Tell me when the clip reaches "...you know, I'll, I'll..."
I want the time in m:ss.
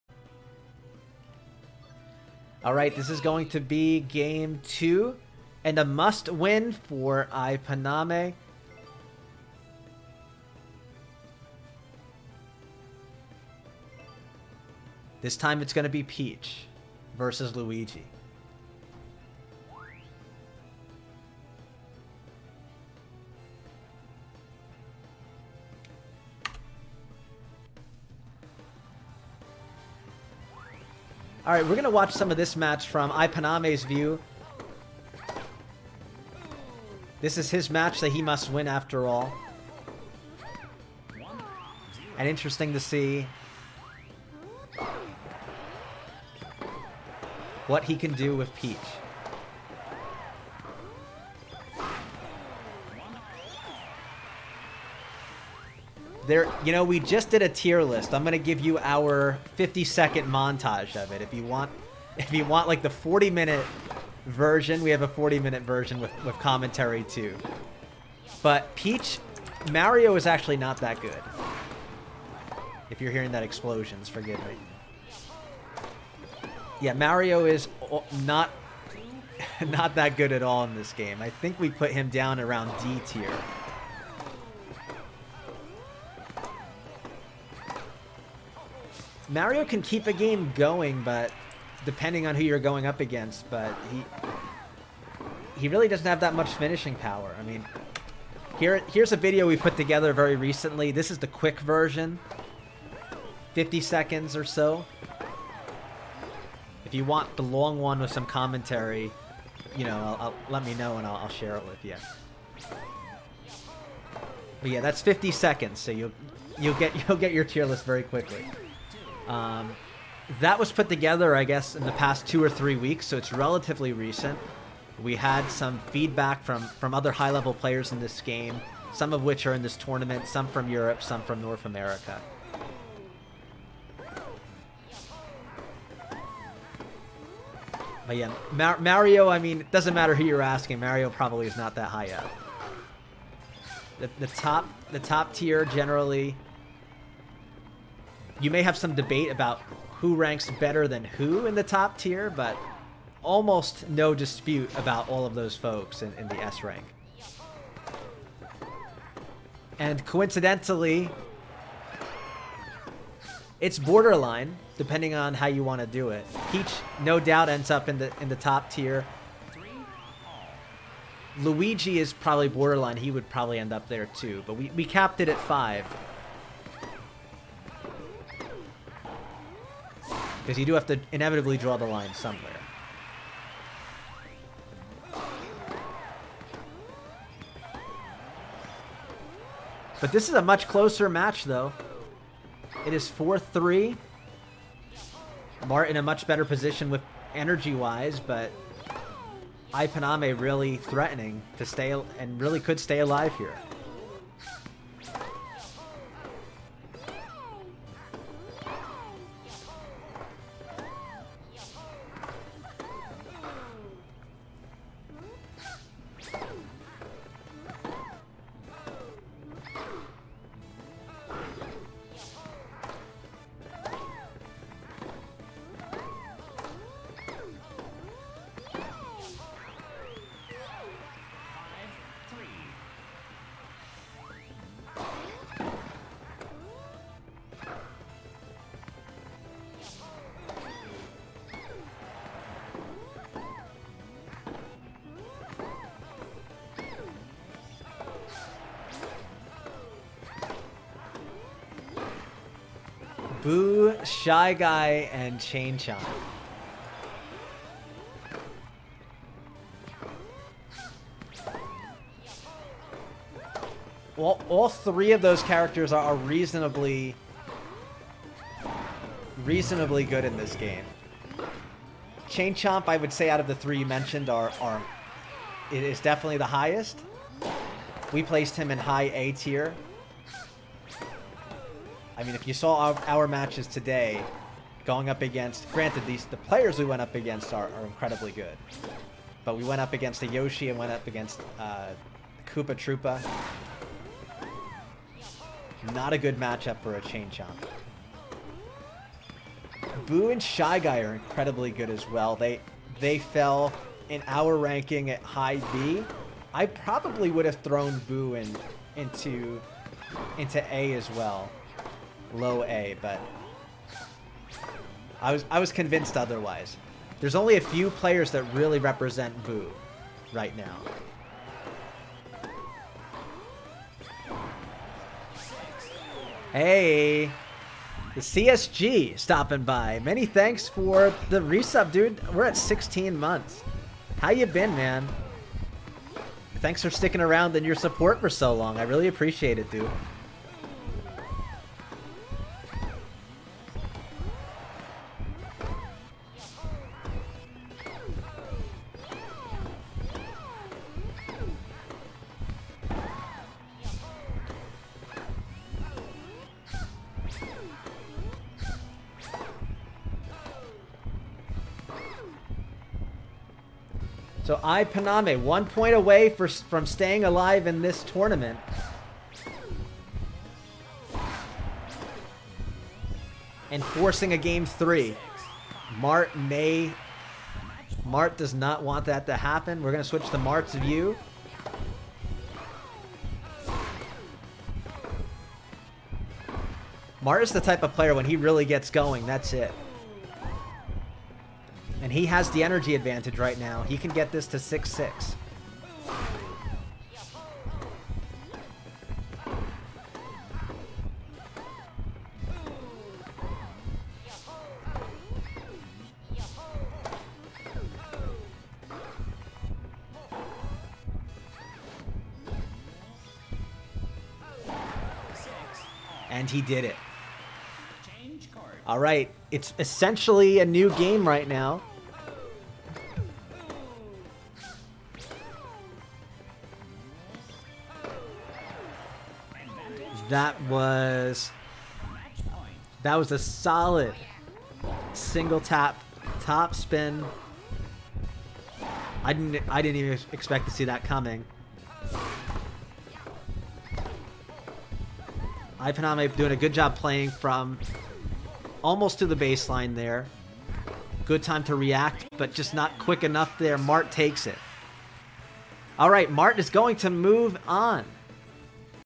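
1:49.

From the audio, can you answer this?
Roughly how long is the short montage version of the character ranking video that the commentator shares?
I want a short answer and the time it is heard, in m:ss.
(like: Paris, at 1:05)
50 seconds, at 0:59.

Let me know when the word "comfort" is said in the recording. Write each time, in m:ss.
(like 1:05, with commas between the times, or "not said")
not said.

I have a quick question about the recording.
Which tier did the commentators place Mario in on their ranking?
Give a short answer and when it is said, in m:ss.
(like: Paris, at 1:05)
D tier, at 1:22.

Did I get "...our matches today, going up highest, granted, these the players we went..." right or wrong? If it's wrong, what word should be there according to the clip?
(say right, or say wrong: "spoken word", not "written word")
wrong: "against", not "highest".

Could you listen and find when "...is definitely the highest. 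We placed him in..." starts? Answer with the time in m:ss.
4:35.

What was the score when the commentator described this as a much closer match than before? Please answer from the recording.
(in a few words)
4-3.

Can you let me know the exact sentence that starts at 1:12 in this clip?
If you're hearing that explosions, forgive me.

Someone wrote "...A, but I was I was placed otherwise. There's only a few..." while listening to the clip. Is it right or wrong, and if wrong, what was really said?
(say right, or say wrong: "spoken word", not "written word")
wrong: "convinced", not "placed".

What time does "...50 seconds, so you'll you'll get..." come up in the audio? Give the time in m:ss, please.
1:55.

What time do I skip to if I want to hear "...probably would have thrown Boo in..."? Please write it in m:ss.
5:06.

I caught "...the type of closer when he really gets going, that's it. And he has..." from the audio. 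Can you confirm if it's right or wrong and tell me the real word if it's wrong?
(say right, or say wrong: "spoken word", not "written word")
wrong: "player", not "closer".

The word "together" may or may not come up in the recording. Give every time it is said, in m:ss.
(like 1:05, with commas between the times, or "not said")
1:39, 2:00.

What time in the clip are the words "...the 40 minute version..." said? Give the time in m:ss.
1:02.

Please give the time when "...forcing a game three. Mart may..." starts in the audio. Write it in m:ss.
6:13.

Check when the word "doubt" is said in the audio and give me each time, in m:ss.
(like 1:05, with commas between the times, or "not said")
2:47.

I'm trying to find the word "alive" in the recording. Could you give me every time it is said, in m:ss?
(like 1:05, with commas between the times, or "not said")
3:22, 6:07.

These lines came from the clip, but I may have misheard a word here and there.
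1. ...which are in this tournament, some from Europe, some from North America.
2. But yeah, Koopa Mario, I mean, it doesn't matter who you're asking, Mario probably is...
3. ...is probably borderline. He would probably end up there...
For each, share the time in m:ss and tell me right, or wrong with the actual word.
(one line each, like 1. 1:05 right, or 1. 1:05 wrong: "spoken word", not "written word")
1. 2:09 right
2. 2:18 wrong: "Mar", not "Koopa"
3. 2:51 right.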